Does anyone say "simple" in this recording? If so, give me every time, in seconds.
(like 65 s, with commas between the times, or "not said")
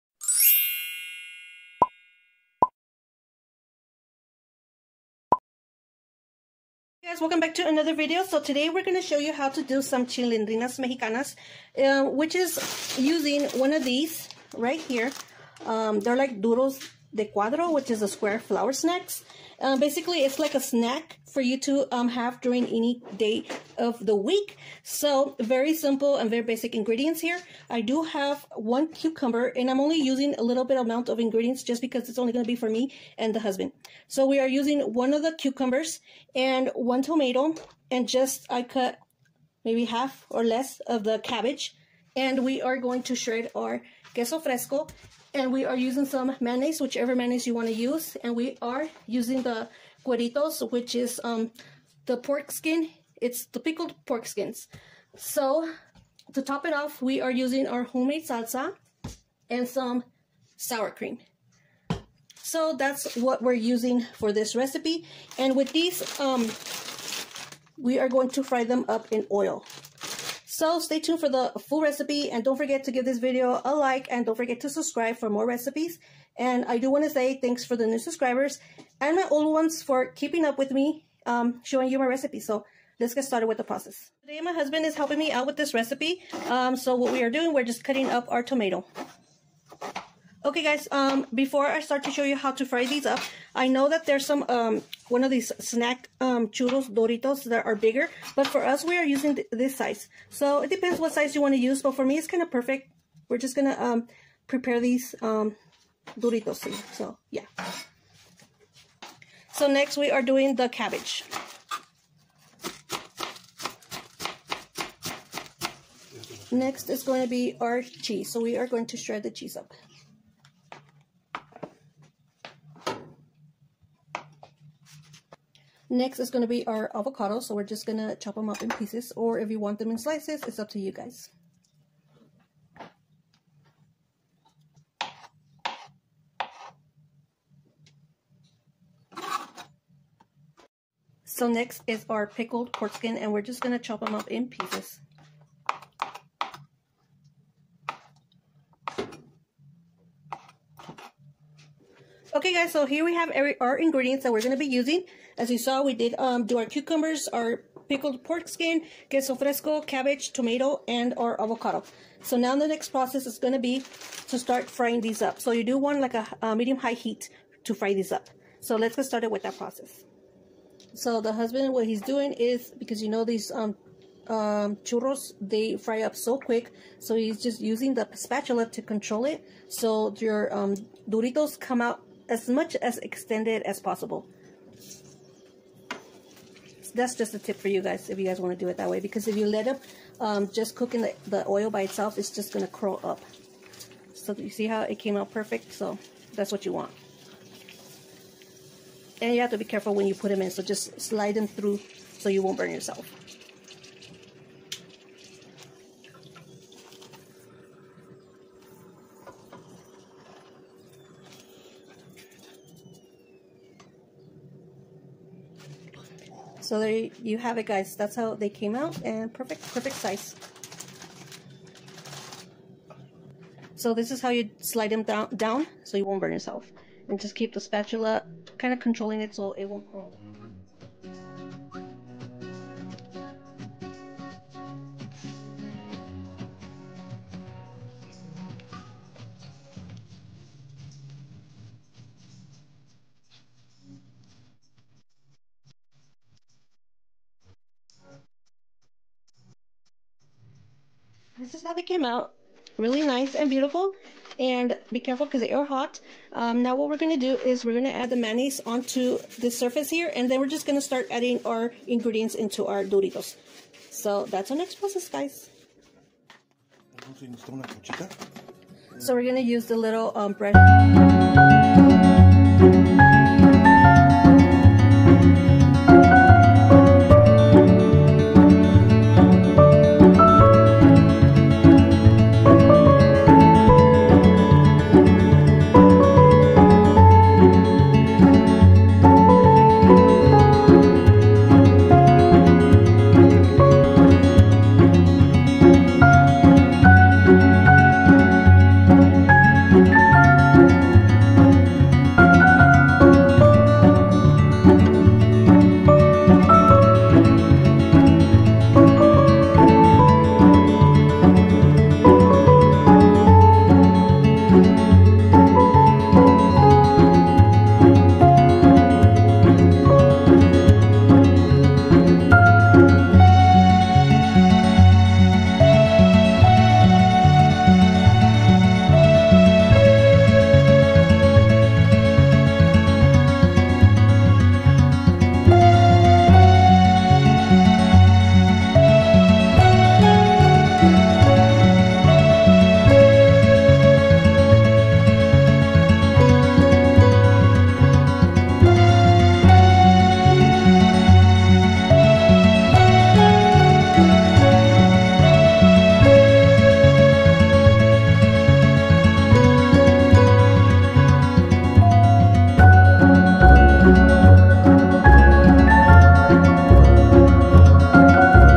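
25 s.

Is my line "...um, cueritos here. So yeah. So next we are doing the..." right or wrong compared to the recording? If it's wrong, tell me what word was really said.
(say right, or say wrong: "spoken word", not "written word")
wrong: "duritos", not "cueritos".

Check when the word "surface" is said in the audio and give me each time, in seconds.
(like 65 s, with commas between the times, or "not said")
259 s.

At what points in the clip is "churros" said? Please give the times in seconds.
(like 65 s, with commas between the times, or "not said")
96 s, 174 s.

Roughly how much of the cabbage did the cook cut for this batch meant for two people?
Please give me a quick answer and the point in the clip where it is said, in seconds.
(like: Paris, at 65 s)
half or less, at 39 s.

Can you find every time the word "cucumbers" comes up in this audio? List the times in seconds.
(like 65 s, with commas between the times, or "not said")
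28 s, 35 s, 156 s.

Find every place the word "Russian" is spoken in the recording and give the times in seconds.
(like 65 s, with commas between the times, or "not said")
not said.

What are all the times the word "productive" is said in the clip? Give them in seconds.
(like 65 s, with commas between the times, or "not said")
not said.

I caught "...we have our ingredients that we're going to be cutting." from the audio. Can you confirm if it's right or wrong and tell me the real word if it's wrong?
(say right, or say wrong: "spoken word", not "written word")
wrong: "using", not "cutting".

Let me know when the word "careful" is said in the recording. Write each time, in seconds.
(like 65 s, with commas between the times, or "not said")
199 s, 255 s.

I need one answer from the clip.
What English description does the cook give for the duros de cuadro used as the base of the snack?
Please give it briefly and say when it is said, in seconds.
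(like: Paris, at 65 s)
square flour snacks, at 18 s.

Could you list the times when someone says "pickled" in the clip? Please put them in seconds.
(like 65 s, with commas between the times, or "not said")
53 s, 142 s, 157 s.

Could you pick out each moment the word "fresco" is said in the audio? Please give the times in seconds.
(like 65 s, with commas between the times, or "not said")
44 s, 159 s.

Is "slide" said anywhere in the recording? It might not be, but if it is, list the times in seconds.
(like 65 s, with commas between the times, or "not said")
200 s, 224 s.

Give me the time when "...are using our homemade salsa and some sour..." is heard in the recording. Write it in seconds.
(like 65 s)
57 s.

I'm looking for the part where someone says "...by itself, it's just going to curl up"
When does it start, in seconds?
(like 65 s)
191 s.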